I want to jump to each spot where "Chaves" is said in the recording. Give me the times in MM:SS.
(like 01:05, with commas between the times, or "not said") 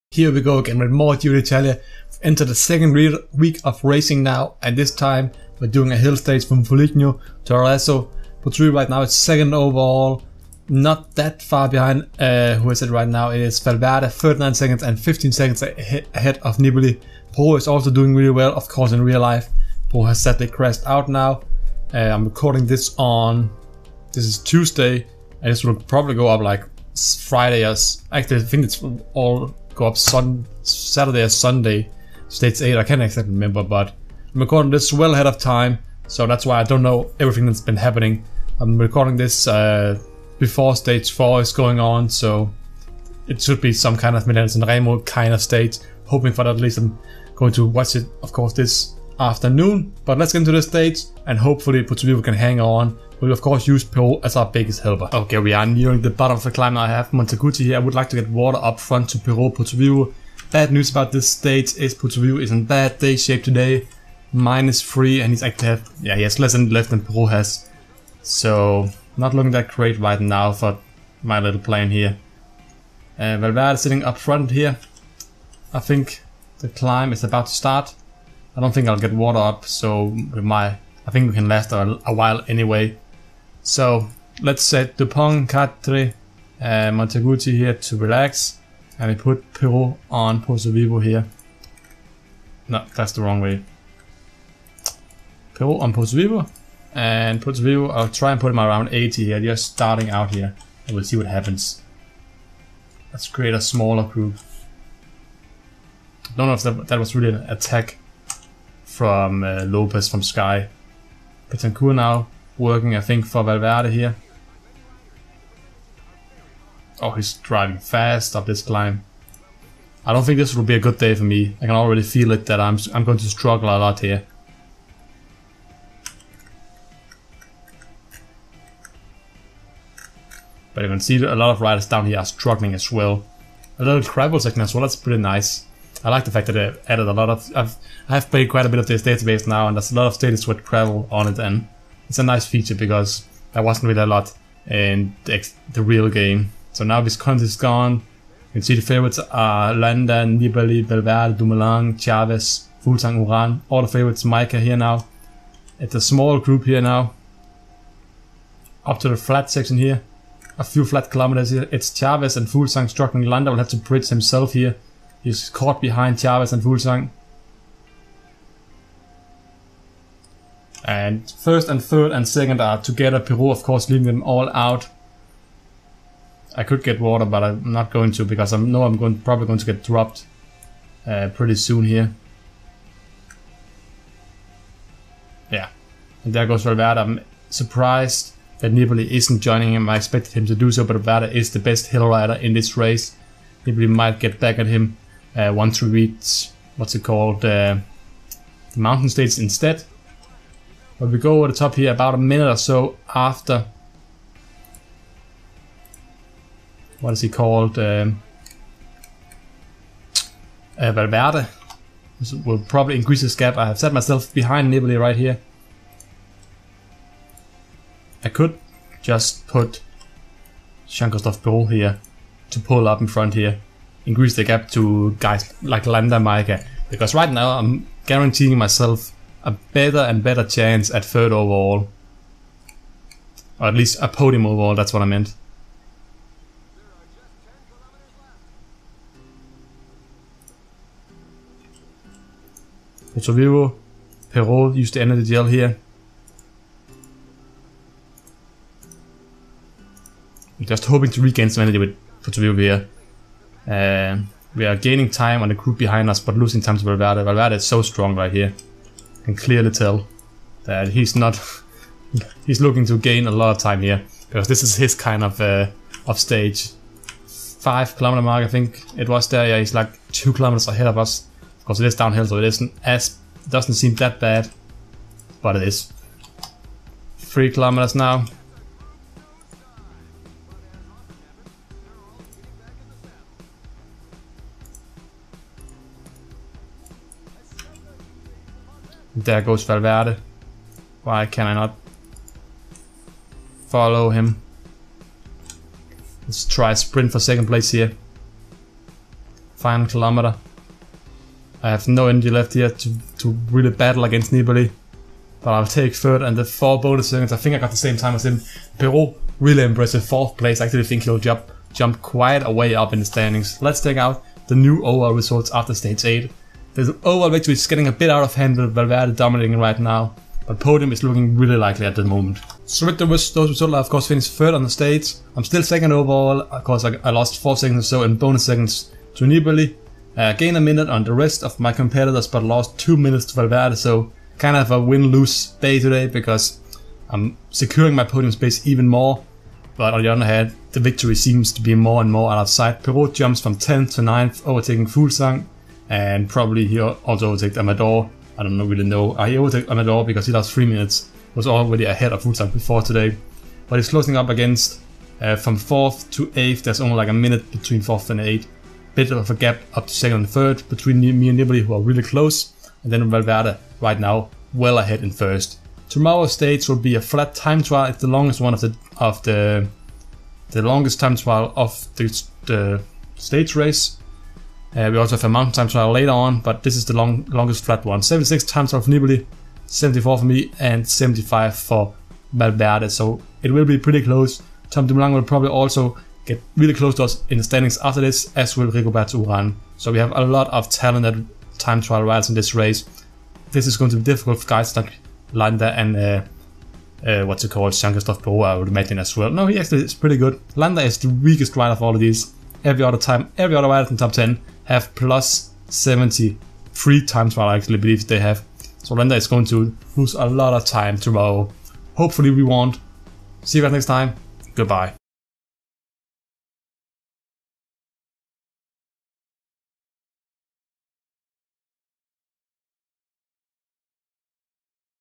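02:31, 02:41, 02:46.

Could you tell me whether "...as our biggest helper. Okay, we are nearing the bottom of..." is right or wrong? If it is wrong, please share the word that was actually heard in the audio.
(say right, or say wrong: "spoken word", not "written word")
right.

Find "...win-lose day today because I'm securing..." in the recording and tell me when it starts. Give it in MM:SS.
05:34.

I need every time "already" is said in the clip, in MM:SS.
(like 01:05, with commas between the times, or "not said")
02:01, 05:51.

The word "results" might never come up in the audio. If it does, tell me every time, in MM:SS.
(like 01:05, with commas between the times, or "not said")
05:15, 05:23.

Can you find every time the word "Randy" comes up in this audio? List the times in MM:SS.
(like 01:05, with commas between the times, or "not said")
not said.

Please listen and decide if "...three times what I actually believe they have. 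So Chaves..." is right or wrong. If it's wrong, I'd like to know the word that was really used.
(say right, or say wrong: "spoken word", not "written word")
wrong: "Landa", not "Chaves".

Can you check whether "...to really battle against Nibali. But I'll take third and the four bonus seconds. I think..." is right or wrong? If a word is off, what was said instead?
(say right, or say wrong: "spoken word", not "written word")
right.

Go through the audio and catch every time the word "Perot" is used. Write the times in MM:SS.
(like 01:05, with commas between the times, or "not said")
00:59, 05:42.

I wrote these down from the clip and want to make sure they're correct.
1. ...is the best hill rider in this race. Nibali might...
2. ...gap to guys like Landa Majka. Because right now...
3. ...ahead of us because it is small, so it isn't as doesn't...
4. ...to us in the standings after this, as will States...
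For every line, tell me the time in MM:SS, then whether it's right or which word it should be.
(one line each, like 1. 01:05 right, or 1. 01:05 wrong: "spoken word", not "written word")
1. 03:11 right
2. 03:44 right
3. 04:30 wrong: "downhill", not "small"
4. 06:26 wrong: "Rigoberto", not "States".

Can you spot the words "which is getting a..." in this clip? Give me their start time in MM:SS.
05:17.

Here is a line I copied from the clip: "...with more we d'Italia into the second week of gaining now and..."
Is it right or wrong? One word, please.
wrong.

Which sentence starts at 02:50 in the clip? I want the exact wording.
And first and third and second are together.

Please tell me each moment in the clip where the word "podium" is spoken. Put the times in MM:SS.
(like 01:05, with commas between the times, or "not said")
03:54, 05:20, 05:38.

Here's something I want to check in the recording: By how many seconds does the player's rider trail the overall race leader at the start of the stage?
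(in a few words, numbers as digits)
39.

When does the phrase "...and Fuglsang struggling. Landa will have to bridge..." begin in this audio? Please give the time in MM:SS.
02:42.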